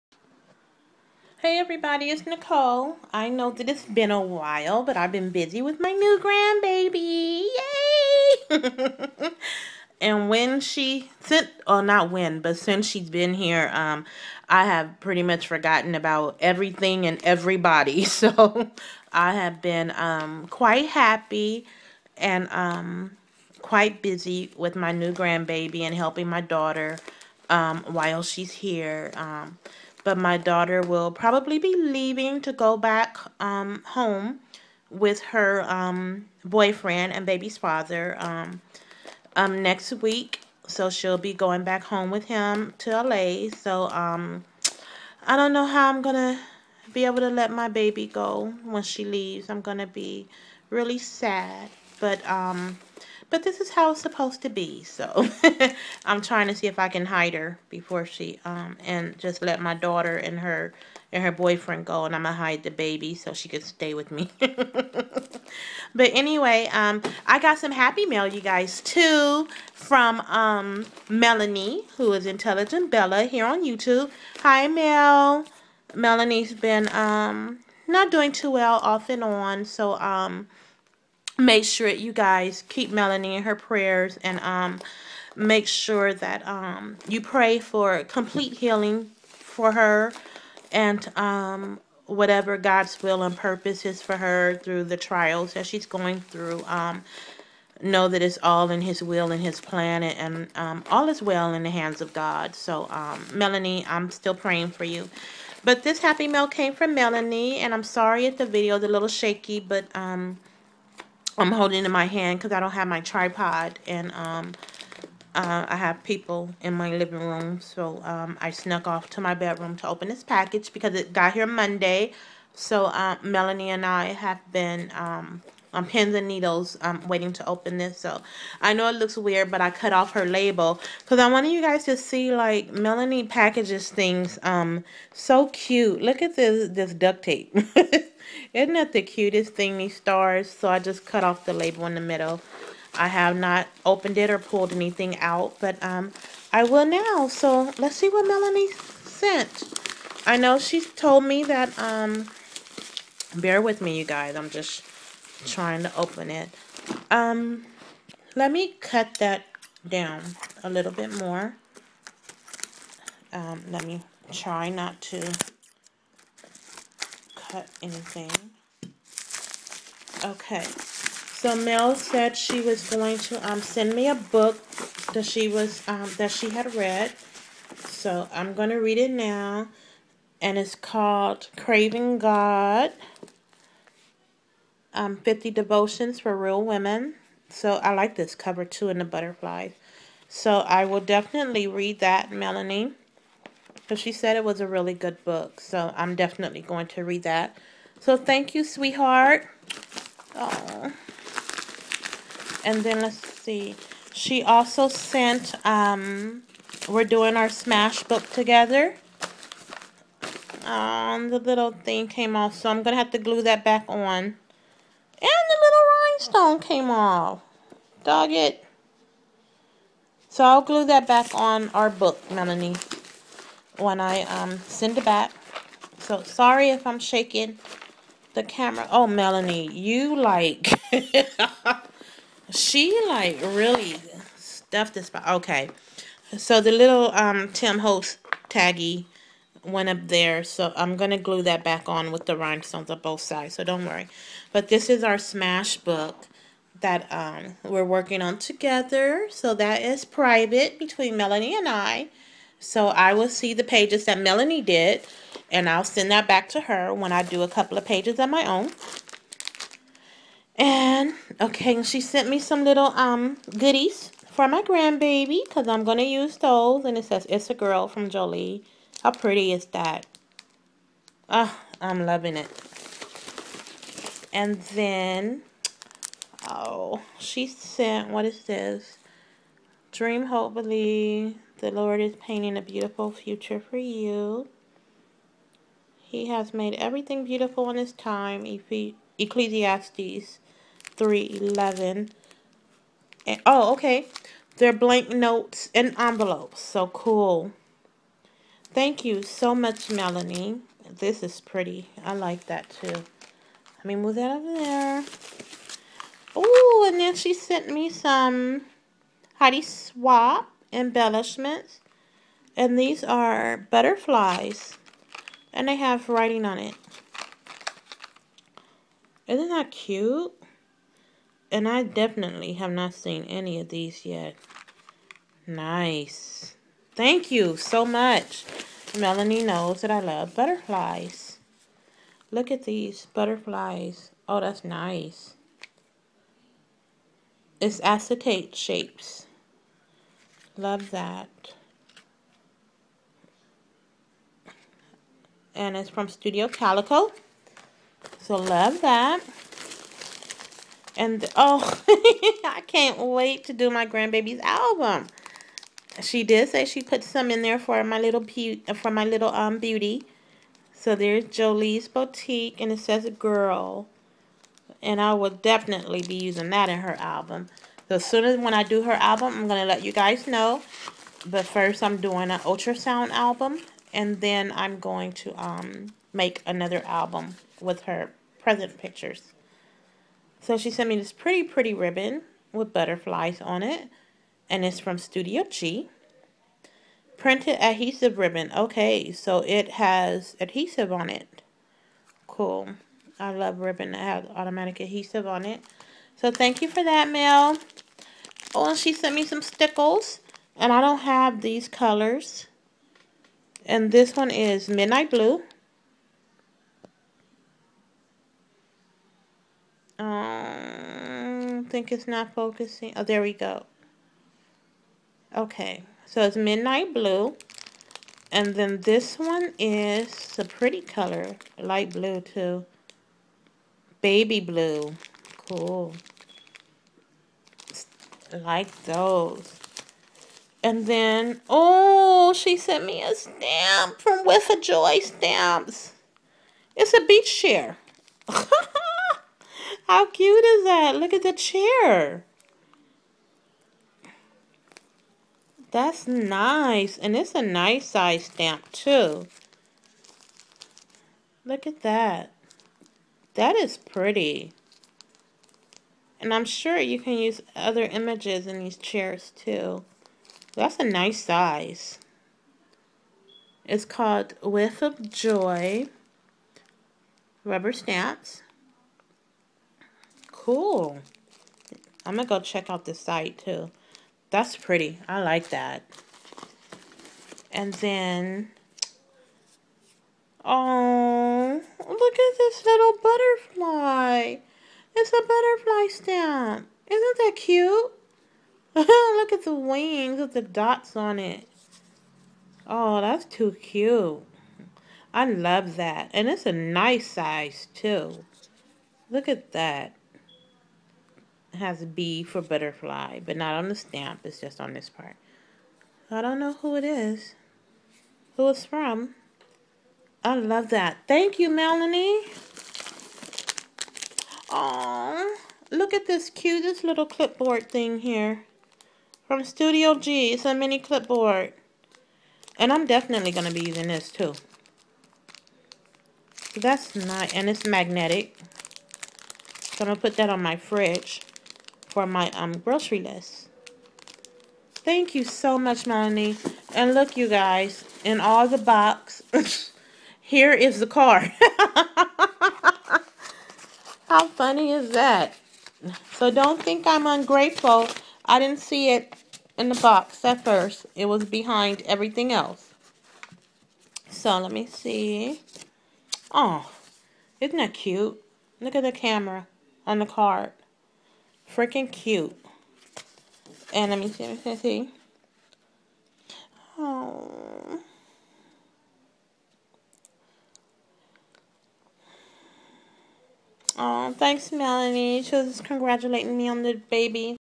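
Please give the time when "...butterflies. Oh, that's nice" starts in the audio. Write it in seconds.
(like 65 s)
333 s.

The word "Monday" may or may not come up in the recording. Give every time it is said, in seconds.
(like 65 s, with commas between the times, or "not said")
121 s.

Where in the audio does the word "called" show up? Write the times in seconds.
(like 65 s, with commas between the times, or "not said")
180 s, 463 s.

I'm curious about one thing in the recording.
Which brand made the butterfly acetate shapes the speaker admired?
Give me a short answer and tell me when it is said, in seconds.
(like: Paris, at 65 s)
Studio Calico, at 346 s.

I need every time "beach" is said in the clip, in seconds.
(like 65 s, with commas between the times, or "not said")
437 s.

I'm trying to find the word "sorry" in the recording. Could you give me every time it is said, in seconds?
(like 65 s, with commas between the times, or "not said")
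107 s, 226 s.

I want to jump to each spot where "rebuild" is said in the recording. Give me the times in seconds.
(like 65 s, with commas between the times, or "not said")
not said.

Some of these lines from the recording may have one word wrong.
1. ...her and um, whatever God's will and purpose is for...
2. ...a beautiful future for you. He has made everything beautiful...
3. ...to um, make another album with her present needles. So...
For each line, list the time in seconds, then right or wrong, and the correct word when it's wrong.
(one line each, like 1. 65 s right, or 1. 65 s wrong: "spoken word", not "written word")
1. 89 s right
2. 282 s right
3. 375 s wrong: "pictures", not "needles".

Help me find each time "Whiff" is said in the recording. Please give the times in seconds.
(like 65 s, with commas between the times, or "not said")
434 s, 464 s.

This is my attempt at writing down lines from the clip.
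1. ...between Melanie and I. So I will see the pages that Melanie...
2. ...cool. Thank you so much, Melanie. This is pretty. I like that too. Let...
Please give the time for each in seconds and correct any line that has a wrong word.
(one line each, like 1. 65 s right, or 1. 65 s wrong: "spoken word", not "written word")
1. 250 s right
2. 296 s right.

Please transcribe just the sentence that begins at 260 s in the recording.
And, okay, she sent me some little um goodies for my grandbaby, because I'm going to use those.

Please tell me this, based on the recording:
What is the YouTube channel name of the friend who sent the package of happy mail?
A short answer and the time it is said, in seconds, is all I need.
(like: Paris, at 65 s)
Intelligent Bella, at 72 s.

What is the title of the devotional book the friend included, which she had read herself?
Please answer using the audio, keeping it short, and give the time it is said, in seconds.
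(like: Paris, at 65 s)
Craving God, at 181 s.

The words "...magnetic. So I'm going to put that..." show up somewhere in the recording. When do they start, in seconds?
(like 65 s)
527 s.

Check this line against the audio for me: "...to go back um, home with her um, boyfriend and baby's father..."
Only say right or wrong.
right.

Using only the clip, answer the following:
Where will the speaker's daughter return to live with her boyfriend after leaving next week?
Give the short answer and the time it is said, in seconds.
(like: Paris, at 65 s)
LA, at 43 s.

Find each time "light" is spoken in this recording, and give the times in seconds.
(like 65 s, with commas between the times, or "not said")
421 s.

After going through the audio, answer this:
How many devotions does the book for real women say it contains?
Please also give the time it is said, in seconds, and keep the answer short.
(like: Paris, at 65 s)
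50, at 185 s.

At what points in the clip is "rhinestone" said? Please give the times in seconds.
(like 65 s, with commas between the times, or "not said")
216 s, 242 s.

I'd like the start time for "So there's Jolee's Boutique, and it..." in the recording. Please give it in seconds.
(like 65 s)
360 s.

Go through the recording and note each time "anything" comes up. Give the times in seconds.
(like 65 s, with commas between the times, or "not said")
144 s, 167 s.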